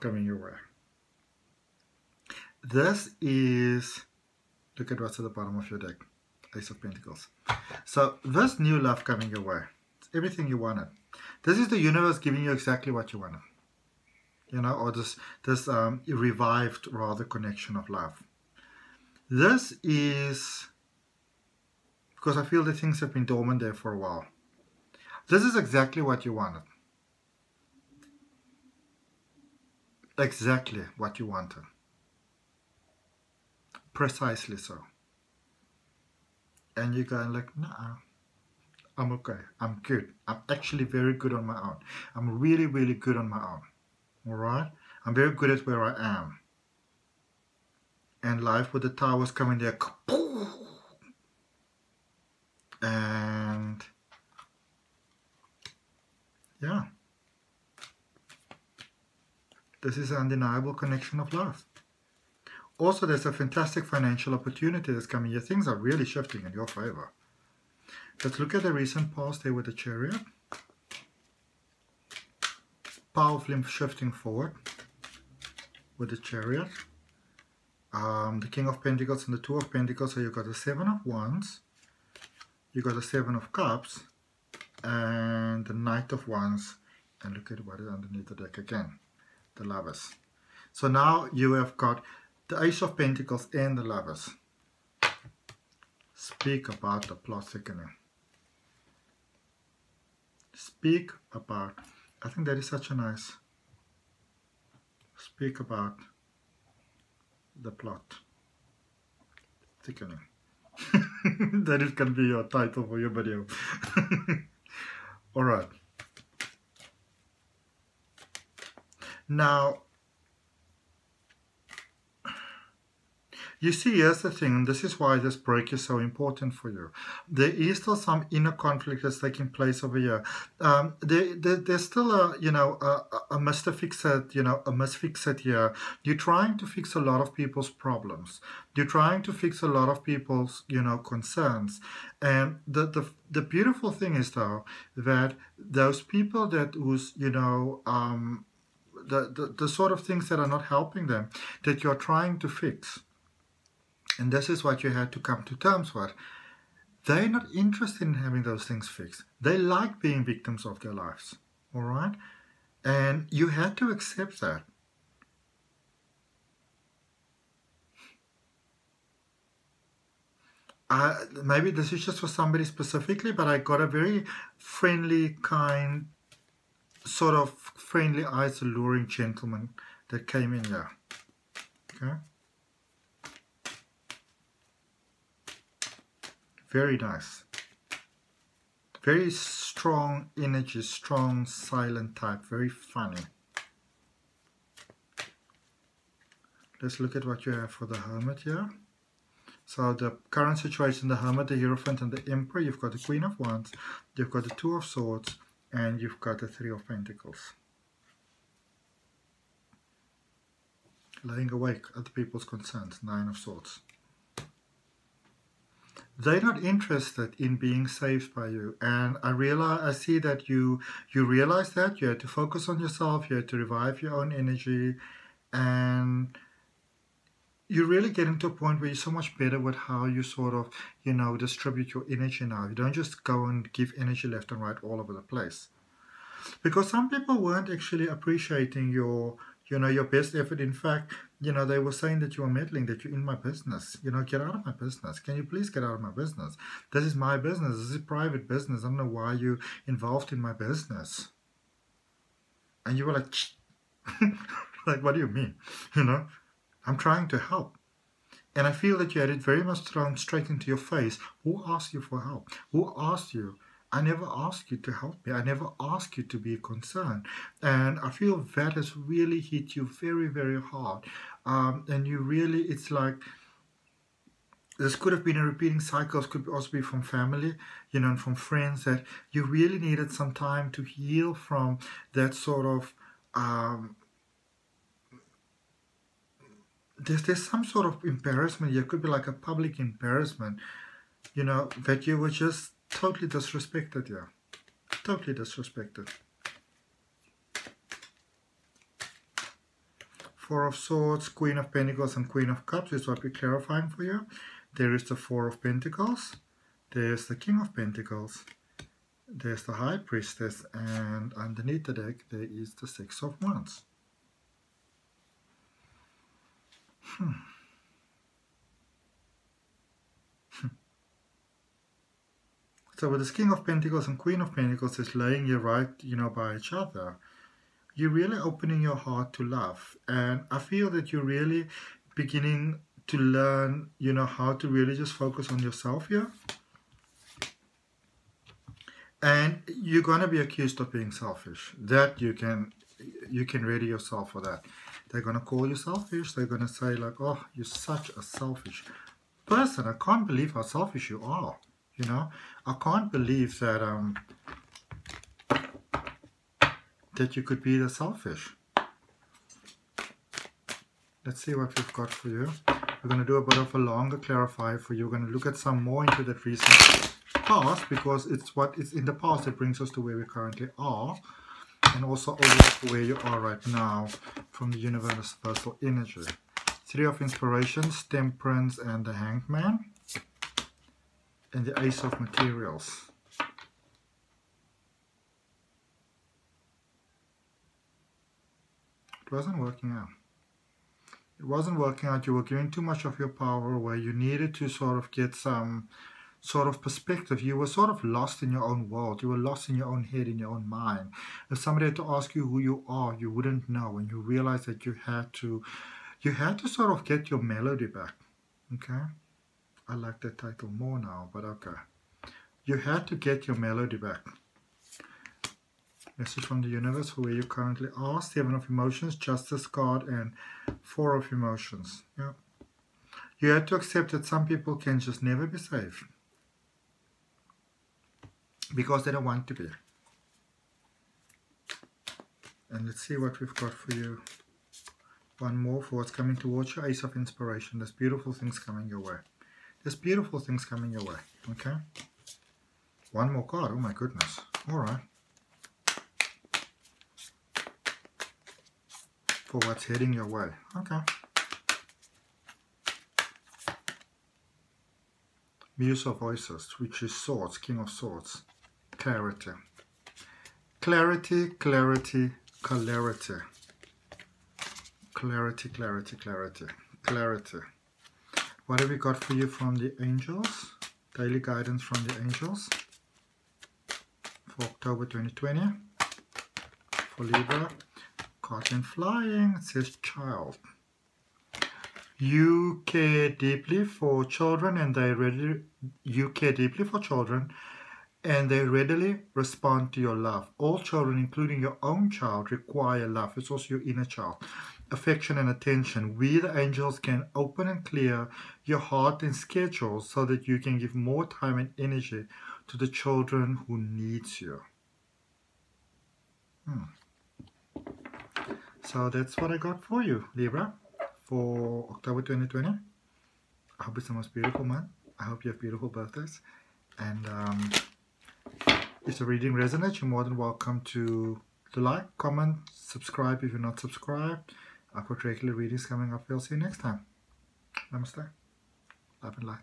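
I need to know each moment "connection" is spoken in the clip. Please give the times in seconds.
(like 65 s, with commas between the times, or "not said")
17 s, 60 s.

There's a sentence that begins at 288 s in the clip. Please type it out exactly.
It could be like a public embarrassment, you know, that you were just totally disrespected.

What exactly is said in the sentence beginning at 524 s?
I've got regular readings coming up.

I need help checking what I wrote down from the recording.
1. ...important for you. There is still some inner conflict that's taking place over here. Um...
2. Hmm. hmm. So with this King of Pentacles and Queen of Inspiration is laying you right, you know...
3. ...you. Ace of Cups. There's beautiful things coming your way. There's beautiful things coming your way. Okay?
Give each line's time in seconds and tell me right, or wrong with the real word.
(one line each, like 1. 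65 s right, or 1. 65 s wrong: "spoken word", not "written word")
1. 125 s right
2. 317 s wrong: "Pentacles", not "Inspiration"
3. 436 s wrong: "Inspiration", not "Cups".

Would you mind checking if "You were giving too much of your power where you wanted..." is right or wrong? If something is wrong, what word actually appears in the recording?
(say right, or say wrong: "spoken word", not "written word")
wrong: "needed", not "wanted".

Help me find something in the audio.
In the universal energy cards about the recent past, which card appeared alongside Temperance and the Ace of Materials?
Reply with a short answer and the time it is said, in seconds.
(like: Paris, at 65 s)
The Hangman, at 379 s.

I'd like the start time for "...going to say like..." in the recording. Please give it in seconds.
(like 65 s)
346 s.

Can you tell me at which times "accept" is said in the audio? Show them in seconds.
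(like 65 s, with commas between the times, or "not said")
163 s, 423 s.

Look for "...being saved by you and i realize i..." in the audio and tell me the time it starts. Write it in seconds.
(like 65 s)
217 s.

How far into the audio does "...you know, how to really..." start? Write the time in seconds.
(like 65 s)
333 s.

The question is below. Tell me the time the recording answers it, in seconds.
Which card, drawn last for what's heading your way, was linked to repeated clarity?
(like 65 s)
457 s.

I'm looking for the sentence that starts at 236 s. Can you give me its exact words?
Because some people weren't actually appreciating your, you know, your best effort.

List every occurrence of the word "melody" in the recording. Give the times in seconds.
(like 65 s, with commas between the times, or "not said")
407 s, 413 s.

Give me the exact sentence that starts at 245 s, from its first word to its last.
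Can you please get out of my business?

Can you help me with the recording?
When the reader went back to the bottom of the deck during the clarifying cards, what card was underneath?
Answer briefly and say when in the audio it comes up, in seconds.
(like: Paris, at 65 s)
Six of Wands, at 312 s.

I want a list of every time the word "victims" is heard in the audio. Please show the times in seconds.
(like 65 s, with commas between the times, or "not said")
160 s.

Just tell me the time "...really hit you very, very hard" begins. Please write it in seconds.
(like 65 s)
268 s.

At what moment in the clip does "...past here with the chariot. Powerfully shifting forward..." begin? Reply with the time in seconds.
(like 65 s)
69 s.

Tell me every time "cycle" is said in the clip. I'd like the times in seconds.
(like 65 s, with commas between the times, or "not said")
275 s.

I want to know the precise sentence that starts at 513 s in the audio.
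I hope it's the most beautiful month.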